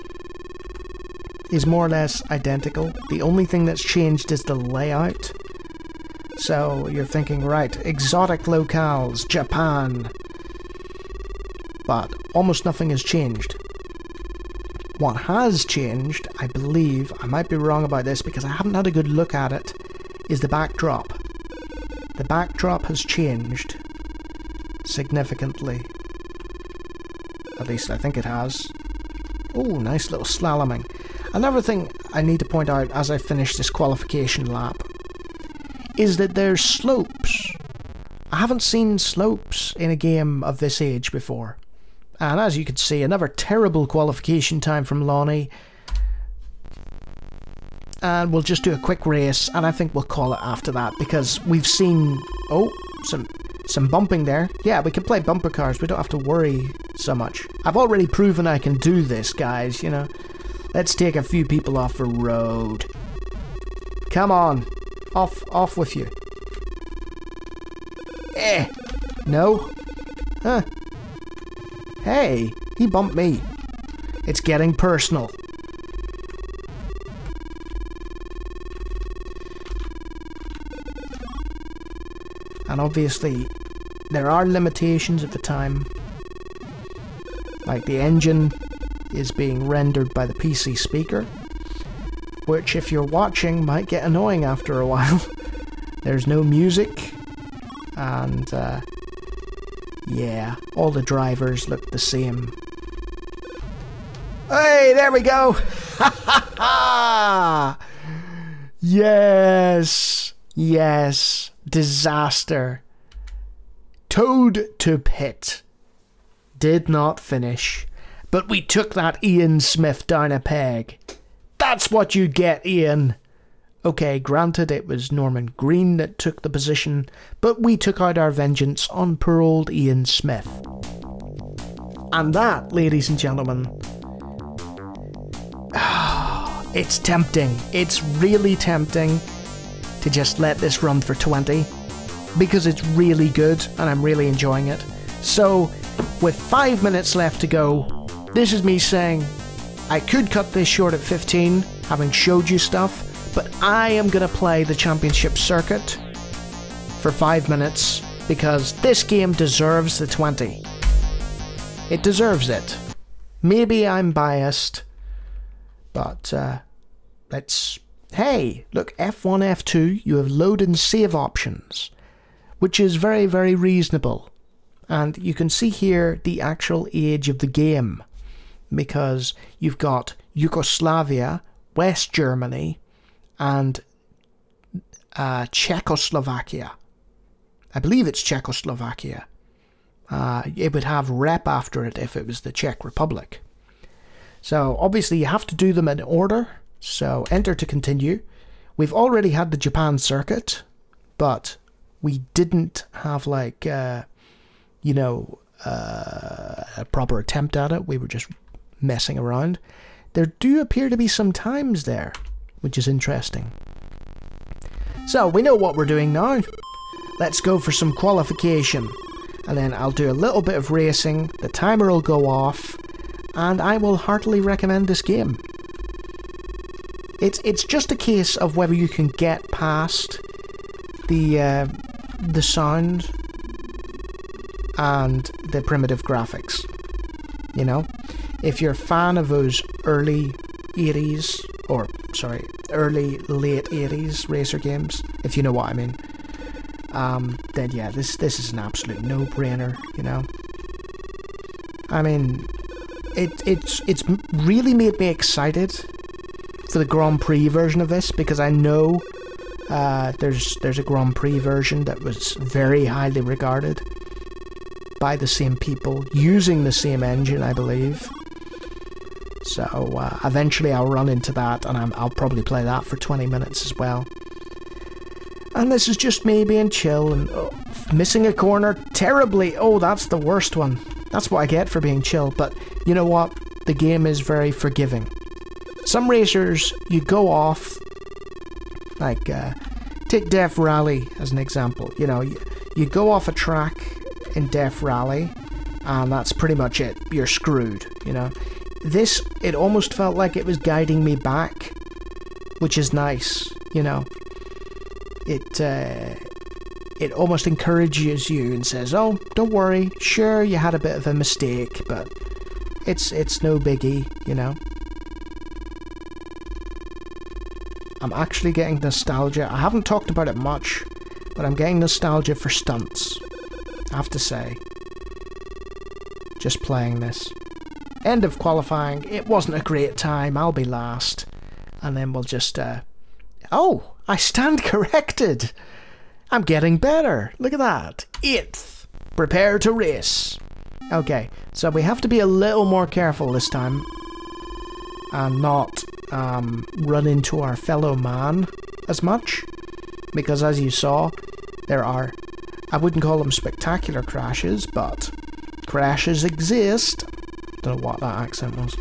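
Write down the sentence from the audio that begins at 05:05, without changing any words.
It, uh, it almost encourages you and says, "Oh, don't worry.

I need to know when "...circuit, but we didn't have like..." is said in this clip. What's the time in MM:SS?
03:19.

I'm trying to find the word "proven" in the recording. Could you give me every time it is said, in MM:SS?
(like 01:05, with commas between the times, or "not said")
00:58.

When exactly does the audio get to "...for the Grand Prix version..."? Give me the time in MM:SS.
04:16.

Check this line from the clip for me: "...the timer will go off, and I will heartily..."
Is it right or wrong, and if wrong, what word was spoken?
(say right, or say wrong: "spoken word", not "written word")
right.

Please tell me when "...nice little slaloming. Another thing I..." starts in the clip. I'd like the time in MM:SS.
00:29.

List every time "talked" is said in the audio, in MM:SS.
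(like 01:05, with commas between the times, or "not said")
05:19.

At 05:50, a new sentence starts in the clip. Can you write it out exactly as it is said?
Because as you saw, there are...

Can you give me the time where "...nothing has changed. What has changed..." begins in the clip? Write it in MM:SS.
00:12.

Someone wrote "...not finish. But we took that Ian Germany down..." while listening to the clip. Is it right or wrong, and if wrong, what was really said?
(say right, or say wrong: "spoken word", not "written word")
wrong: "Smith", not "Germany".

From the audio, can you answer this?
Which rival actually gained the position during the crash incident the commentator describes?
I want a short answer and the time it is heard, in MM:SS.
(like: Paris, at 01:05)
Norman Green, at 02:05.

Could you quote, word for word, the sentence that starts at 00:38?
I haven't seen slopes in a game of this age before.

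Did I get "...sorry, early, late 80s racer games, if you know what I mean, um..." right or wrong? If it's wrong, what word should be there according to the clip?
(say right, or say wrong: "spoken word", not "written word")
right.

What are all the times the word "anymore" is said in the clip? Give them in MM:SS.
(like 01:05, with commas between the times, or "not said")
not said.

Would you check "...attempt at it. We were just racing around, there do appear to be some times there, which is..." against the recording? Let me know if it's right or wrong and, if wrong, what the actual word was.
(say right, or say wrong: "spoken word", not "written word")
wrong: "messing", not "racing".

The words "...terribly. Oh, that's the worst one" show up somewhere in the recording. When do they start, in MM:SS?
04:38.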